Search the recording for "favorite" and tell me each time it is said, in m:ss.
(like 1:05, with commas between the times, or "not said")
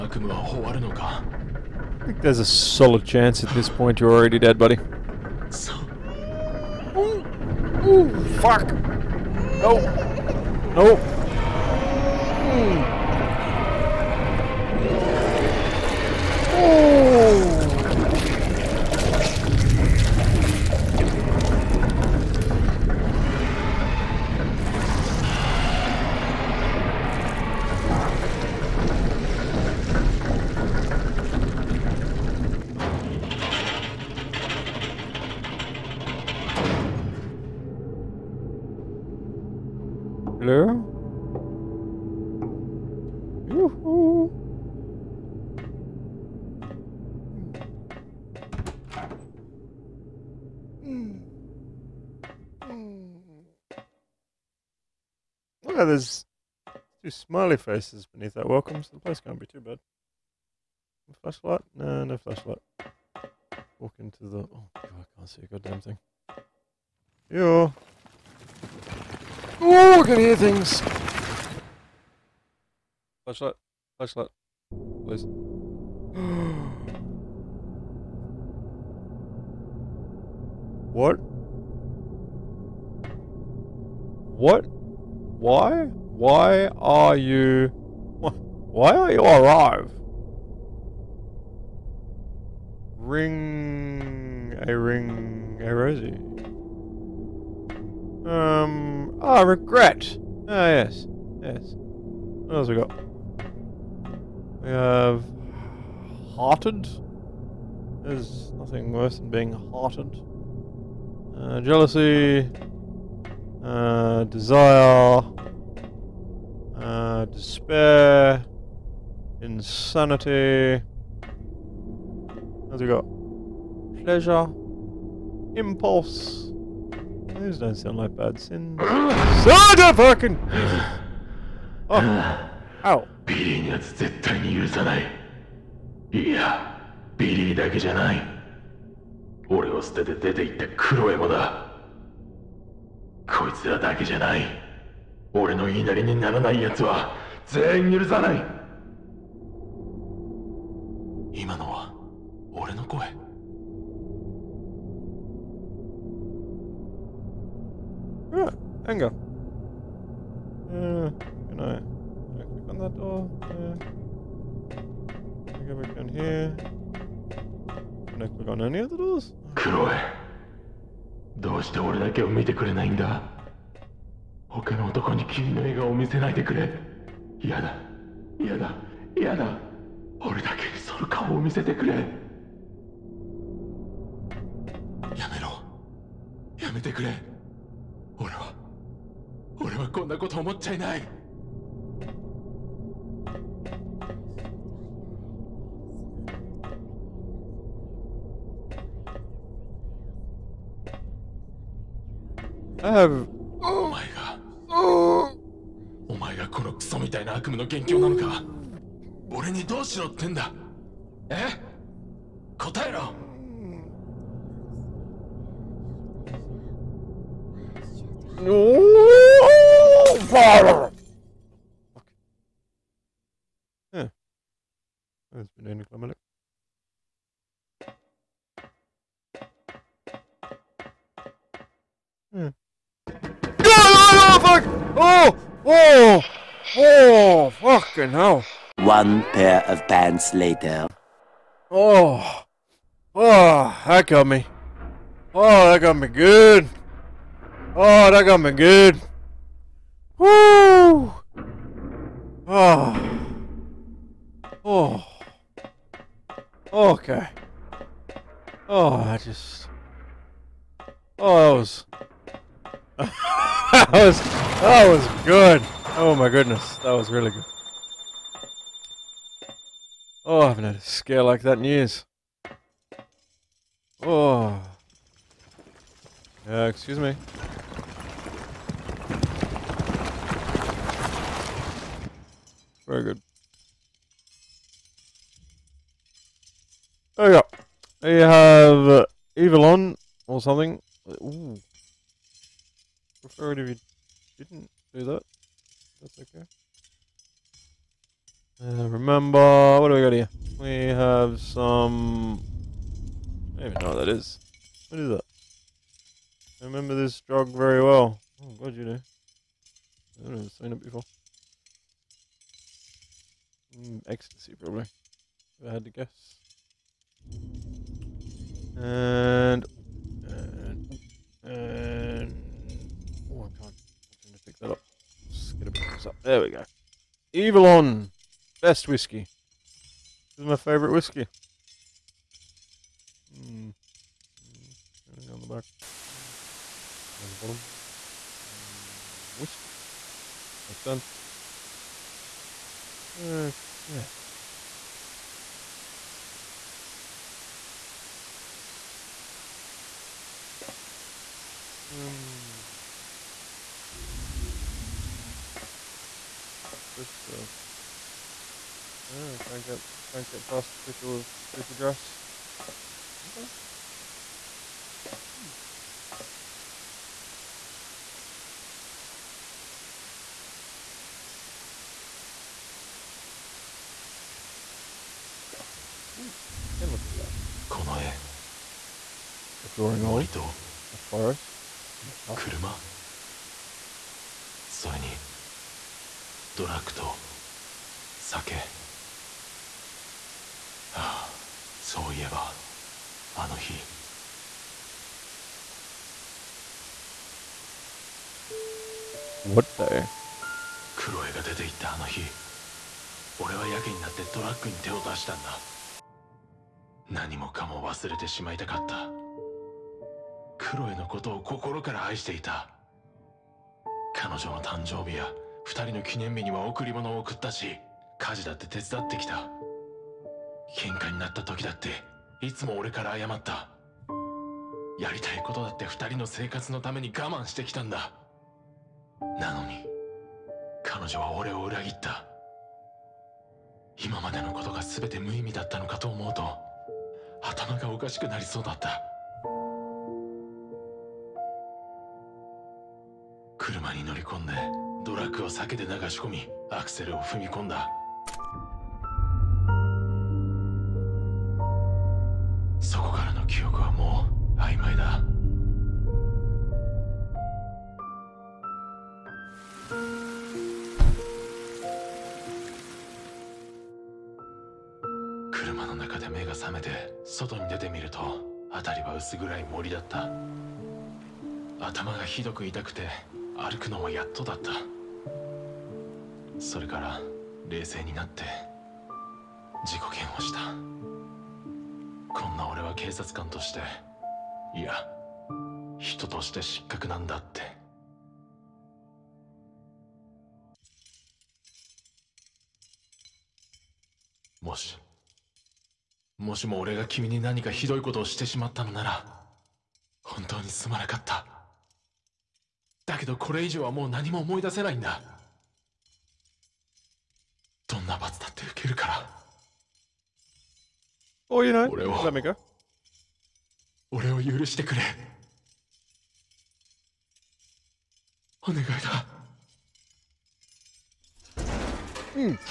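5:30.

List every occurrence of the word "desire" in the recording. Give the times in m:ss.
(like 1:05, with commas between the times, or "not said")
1:54.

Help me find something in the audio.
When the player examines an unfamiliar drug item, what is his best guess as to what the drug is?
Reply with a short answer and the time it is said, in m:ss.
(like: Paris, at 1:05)
ecstasy, at 5:14.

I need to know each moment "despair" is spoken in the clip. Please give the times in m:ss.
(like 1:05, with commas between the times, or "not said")
1:57.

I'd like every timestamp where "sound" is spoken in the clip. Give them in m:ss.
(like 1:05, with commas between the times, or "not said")
2:07.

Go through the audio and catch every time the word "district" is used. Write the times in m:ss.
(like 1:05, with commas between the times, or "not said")
not said.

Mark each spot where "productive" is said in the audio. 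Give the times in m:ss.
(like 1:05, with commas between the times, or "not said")
not said.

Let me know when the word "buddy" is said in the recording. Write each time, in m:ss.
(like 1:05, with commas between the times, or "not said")
0:04.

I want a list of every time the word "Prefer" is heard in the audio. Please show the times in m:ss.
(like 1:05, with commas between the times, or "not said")
4:53.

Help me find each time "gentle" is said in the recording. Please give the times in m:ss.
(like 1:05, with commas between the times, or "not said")
not said.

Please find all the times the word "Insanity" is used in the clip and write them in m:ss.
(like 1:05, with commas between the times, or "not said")
1:59.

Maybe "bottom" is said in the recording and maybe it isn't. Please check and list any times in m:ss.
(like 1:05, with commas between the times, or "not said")
5:37.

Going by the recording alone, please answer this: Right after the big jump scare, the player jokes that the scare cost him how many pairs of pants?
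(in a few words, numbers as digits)
1.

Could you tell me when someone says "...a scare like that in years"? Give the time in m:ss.
4:30.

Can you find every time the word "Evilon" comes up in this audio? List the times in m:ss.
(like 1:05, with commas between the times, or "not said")
4:49.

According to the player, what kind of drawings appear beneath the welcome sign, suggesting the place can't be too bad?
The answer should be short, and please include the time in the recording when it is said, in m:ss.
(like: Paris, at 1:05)
smiley faces, at 0:57.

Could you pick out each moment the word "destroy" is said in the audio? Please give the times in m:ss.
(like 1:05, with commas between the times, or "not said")
not said.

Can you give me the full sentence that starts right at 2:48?
Can I click on any of those?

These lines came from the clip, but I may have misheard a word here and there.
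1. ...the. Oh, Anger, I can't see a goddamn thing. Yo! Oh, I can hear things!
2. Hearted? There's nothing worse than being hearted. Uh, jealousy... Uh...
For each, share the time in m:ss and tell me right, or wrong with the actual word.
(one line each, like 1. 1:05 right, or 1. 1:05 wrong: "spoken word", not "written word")
1. 1:04 wrong: "God", not "Anger"
2. 1:46 right.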